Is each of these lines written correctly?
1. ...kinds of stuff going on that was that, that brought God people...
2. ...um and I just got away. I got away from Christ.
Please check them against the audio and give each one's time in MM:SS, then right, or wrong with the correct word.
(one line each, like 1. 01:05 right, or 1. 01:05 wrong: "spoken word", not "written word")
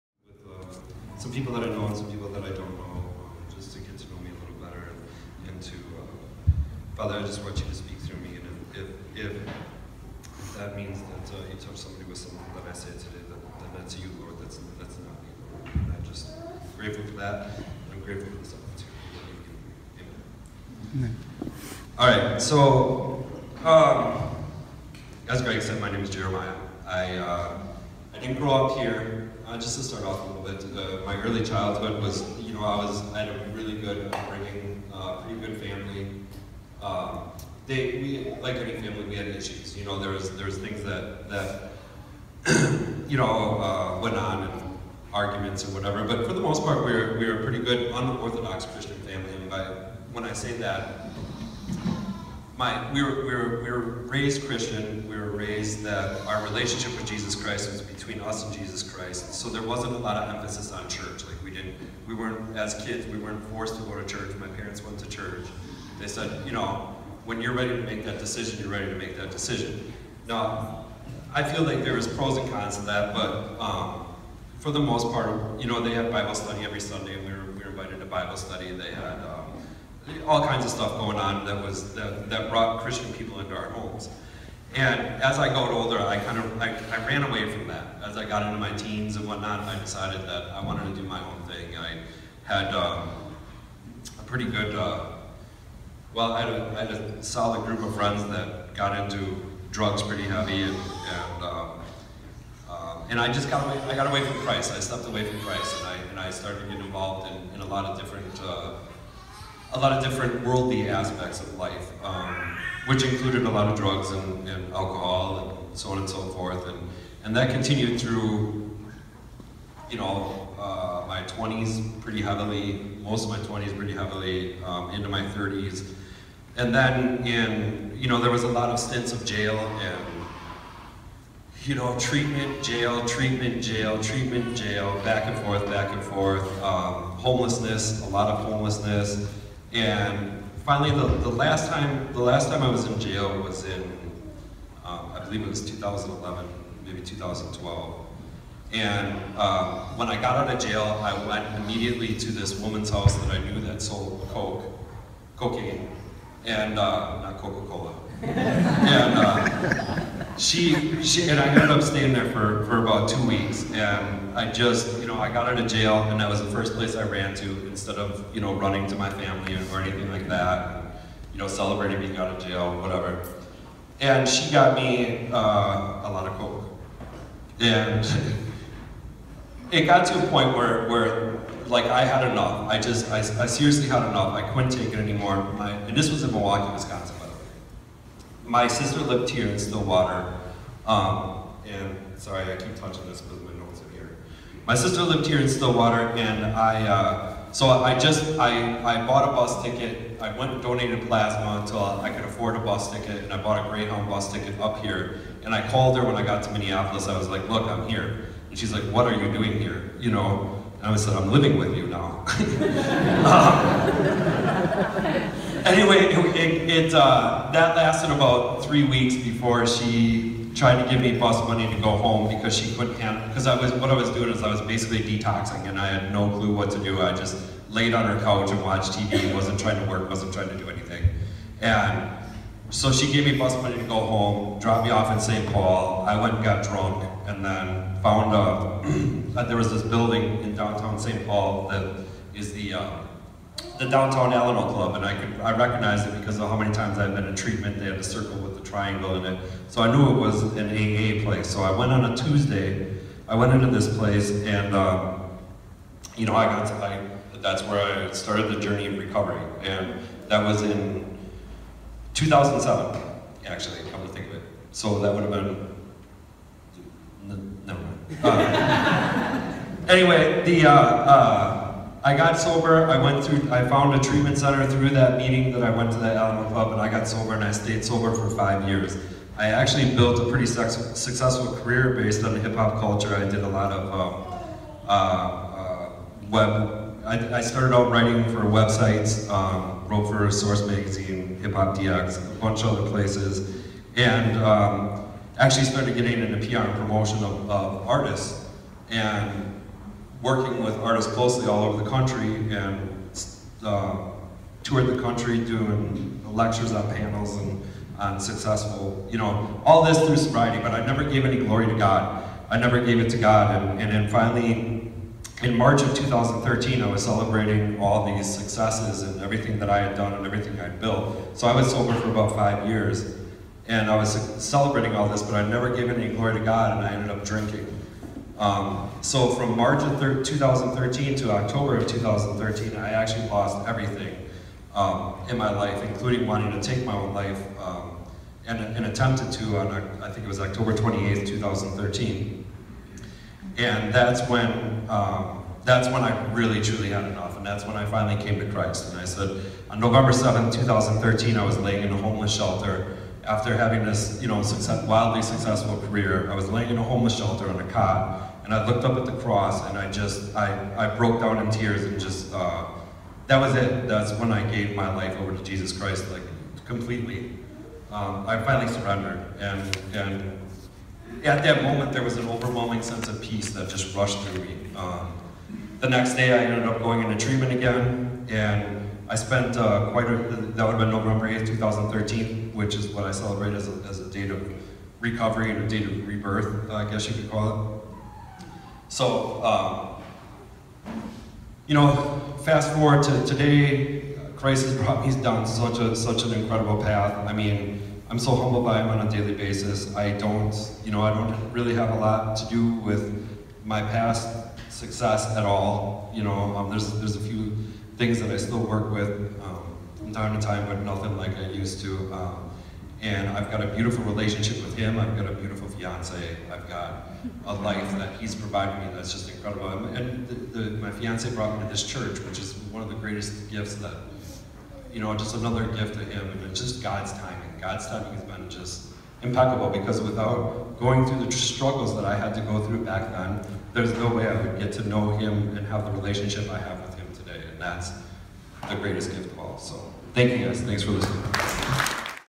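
1. 01:20 wrong: "Christian", not "God"
2. 01:42 right.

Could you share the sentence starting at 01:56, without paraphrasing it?
And, and that continued through, you know, uh, my 20s pretty heavily, most of my 20s pretty heavily, um, into my 30s.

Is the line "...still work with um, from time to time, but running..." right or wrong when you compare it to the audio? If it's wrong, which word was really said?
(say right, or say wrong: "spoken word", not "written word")
wrong: "nothing", not "running".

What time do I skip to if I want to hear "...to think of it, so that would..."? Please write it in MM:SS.
04:24.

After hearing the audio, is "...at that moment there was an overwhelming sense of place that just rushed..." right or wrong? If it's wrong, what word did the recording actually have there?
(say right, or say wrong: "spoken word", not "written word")
wrong: "peace", not "place".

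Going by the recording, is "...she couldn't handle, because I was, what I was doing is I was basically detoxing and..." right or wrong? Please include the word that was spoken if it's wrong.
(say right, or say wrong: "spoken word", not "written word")
right.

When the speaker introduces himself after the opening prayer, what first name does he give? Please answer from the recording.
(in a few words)
Jeremiah.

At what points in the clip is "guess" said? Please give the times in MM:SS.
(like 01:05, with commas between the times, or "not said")
06:26.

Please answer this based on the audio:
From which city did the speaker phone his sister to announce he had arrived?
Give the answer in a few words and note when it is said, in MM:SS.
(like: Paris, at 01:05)
Minneapolis, at 03:26.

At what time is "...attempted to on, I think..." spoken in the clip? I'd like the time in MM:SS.
05:38.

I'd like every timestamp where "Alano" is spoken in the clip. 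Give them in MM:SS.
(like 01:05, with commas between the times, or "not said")
04:04, 04:36.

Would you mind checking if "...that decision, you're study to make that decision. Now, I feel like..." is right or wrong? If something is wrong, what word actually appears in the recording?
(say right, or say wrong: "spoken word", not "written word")
wrong: "ready", not "study".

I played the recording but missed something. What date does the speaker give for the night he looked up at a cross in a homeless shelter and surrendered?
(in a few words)
November 7th, 2013.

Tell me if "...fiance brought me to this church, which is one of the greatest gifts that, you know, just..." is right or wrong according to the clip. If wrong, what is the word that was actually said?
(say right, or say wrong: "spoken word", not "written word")
right.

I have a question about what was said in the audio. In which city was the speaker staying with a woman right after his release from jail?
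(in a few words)
Milwaukee.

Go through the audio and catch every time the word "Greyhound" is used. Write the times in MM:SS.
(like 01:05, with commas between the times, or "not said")
03:23.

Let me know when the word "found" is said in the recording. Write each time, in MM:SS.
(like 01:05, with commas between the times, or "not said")
03:58, 04:33.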